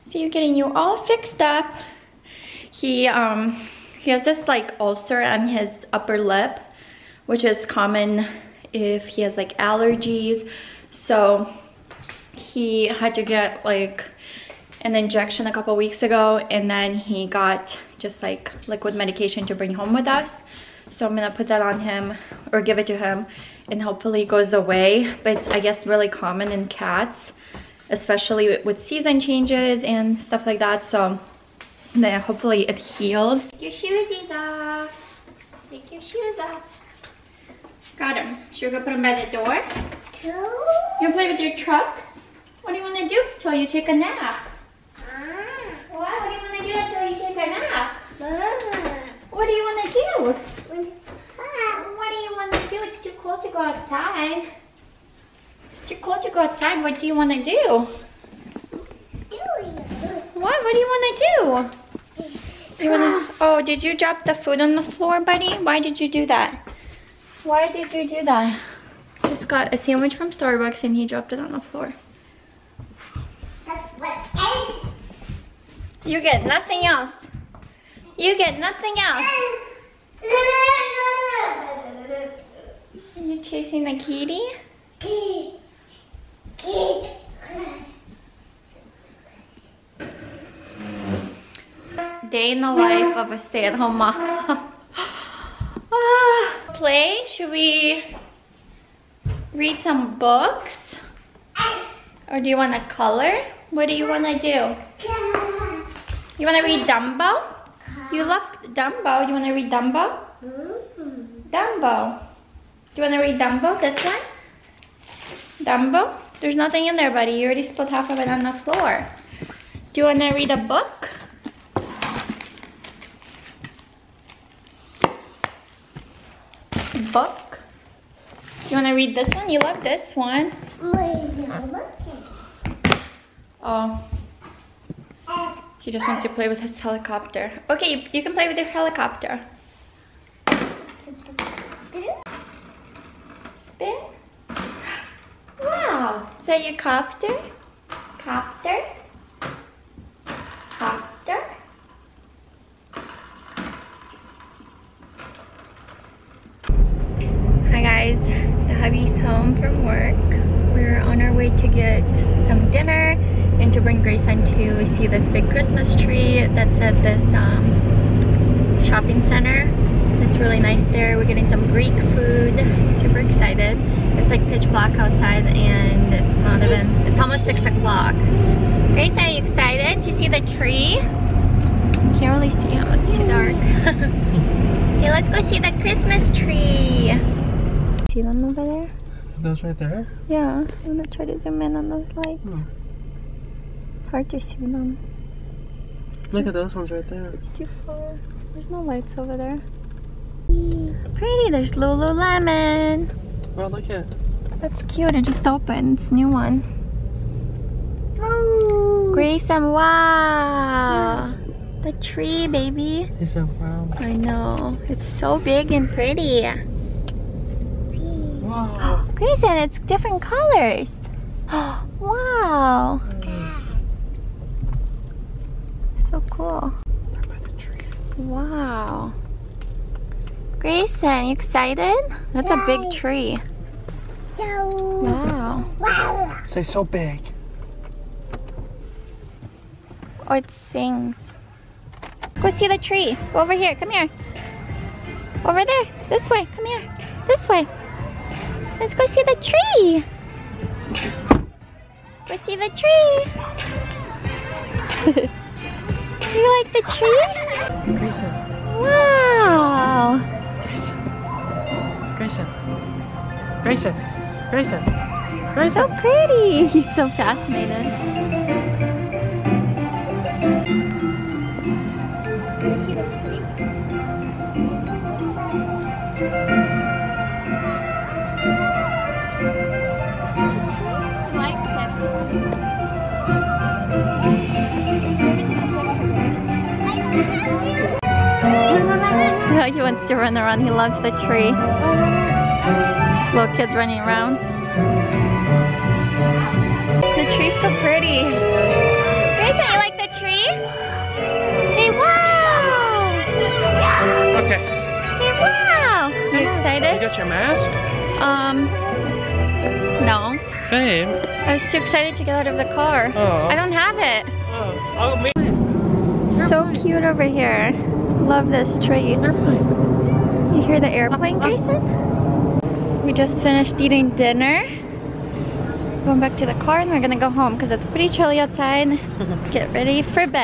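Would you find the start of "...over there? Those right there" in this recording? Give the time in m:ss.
3:08.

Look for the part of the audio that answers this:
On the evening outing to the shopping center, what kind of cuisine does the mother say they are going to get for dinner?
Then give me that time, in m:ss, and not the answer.
2:51.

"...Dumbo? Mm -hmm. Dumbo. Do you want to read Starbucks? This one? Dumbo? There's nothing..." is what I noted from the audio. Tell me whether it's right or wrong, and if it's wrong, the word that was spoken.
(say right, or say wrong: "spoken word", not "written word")
wrong: "Dumbo", not "Starbucks".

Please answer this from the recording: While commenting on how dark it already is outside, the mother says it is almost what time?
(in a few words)
6 o'clock.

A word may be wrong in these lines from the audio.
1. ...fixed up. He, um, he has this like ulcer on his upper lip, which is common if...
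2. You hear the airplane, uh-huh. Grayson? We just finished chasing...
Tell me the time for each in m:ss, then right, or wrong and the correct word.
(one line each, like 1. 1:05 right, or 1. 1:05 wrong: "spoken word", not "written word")
1. 0:00 right
2. 5:19 wrong: "eating", not "chasing".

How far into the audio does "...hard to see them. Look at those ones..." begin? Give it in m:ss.
3:14.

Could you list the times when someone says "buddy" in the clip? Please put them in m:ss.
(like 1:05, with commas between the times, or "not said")
1:05, 1:57.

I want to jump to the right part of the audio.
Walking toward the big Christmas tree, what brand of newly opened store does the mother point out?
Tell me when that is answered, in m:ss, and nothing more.
3:21.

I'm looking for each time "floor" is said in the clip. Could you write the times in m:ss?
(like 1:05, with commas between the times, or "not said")
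1:04, 1:11, 1:58.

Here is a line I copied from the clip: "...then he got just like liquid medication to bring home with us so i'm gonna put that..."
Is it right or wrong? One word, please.
right.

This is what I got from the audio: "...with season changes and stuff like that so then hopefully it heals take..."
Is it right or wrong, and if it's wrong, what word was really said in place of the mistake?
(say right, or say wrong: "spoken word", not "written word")
right.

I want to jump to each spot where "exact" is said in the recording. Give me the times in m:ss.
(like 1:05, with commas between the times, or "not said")
not said.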